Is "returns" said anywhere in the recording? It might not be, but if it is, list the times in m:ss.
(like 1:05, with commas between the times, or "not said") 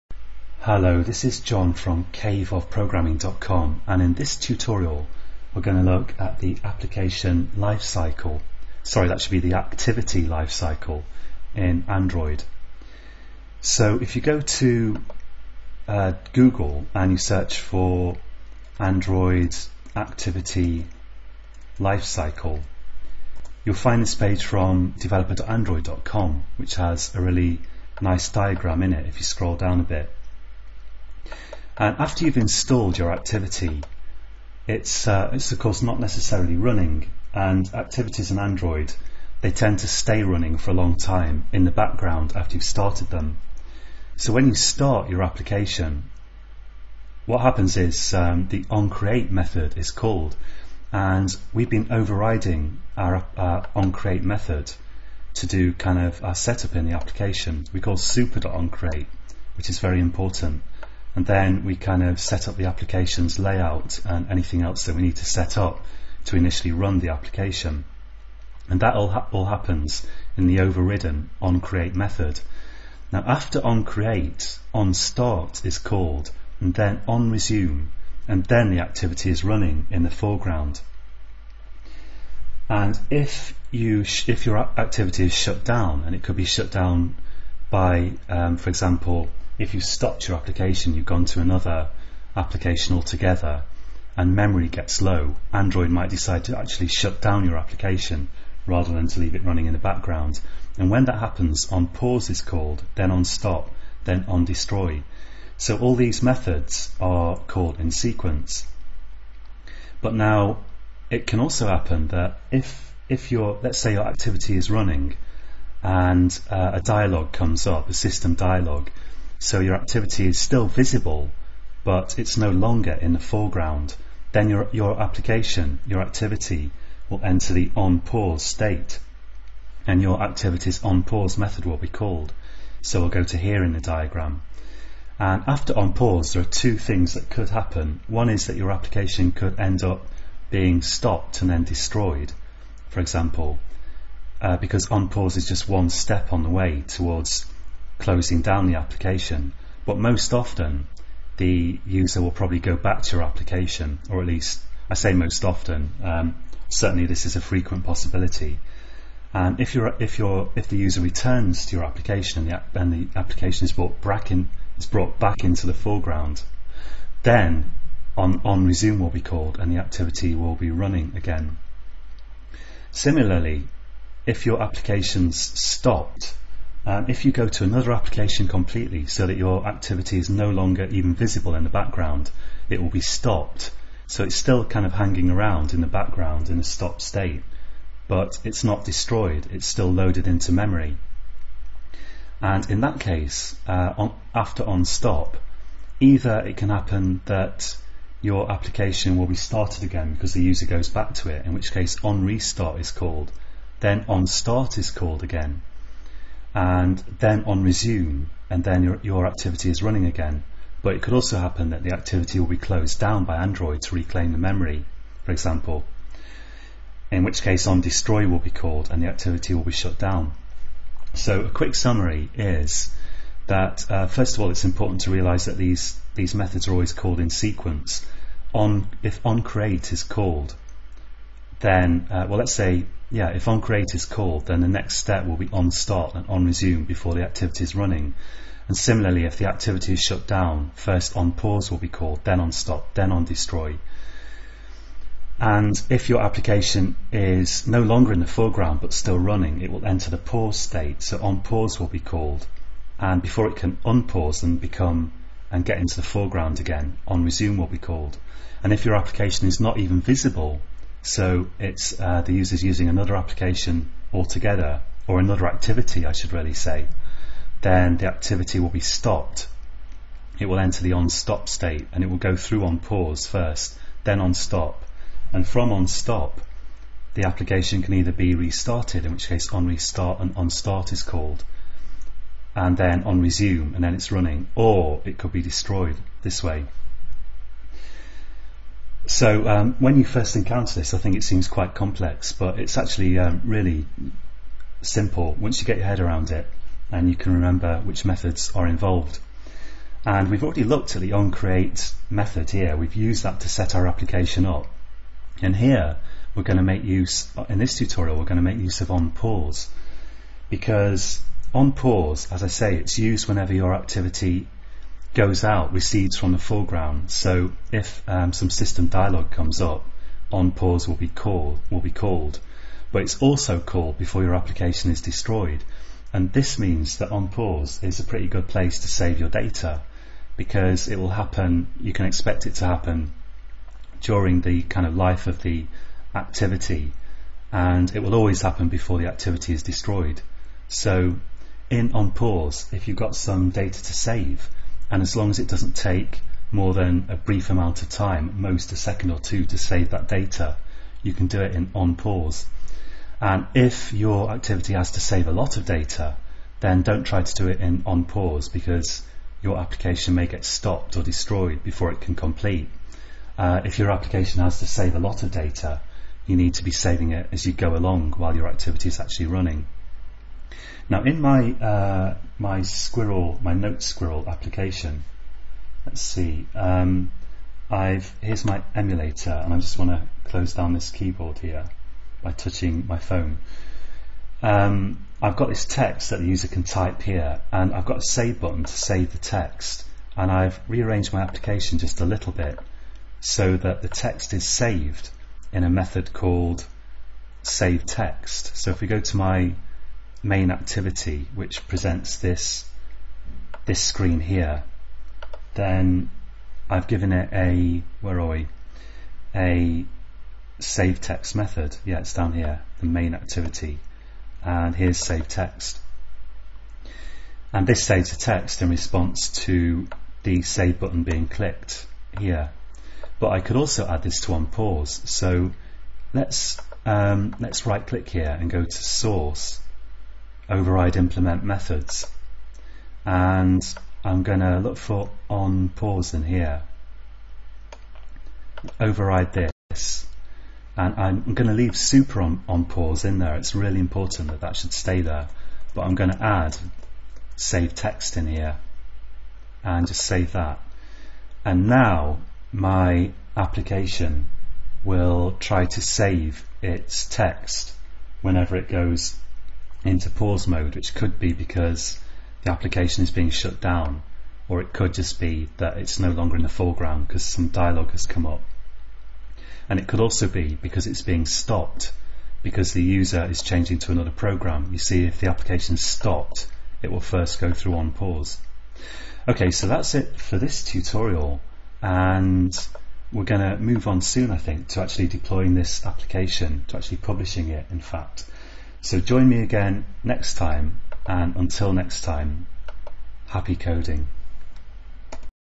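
2:41.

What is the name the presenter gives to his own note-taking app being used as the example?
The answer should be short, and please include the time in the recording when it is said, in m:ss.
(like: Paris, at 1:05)
Note Squirrel, at 6:13.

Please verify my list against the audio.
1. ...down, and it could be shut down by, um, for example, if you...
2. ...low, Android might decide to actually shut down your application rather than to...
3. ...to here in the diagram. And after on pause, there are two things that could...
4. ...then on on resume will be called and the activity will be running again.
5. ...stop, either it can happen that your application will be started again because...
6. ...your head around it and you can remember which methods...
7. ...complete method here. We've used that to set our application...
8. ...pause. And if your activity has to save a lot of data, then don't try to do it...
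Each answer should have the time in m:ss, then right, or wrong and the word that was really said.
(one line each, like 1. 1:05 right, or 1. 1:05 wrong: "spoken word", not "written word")
1. 1:25 right
2. 1:35 right
3. 2:13 right
4. 2:47 right
5. 3:14 right
6. 4:55 right
7. 5:01 wrong: "onCreate", not "complete"
8. 5:51 right.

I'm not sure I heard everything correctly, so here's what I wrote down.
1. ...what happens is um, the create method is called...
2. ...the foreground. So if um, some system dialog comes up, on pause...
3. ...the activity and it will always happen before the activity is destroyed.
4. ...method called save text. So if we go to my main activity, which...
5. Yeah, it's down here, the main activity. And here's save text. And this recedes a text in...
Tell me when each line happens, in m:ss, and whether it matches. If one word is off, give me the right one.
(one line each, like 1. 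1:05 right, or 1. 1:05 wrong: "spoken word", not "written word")
1. 0:47 wrong: "onCreate", not "create"
2. 5:16 right
3. 5:35 right
4. 6:35 right
5. 6:51 wrong: "saves", not "recedes".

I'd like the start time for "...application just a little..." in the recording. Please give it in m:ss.
6:31.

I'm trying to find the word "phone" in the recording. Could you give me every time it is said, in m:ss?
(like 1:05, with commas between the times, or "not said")
6:22.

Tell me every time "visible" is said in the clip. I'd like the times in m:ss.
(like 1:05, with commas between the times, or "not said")
2:00, 3:01, 4:20.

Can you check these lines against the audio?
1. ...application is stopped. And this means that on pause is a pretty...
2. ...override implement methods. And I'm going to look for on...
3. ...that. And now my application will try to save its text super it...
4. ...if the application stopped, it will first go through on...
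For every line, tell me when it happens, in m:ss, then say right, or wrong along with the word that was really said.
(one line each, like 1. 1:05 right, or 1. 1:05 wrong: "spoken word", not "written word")
1. 5:24 wrong: "destroyed", not "stopped"
2. 7:10 right
3. 7:30 wrong: "whenever", not "super"
4. 7:55 right.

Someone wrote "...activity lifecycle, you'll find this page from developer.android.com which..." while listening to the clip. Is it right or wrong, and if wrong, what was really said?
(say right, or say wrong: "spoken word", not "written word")
right.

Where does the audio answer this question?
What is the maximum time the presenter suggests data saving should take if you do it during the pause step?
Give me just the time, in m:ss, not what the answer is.
5:48.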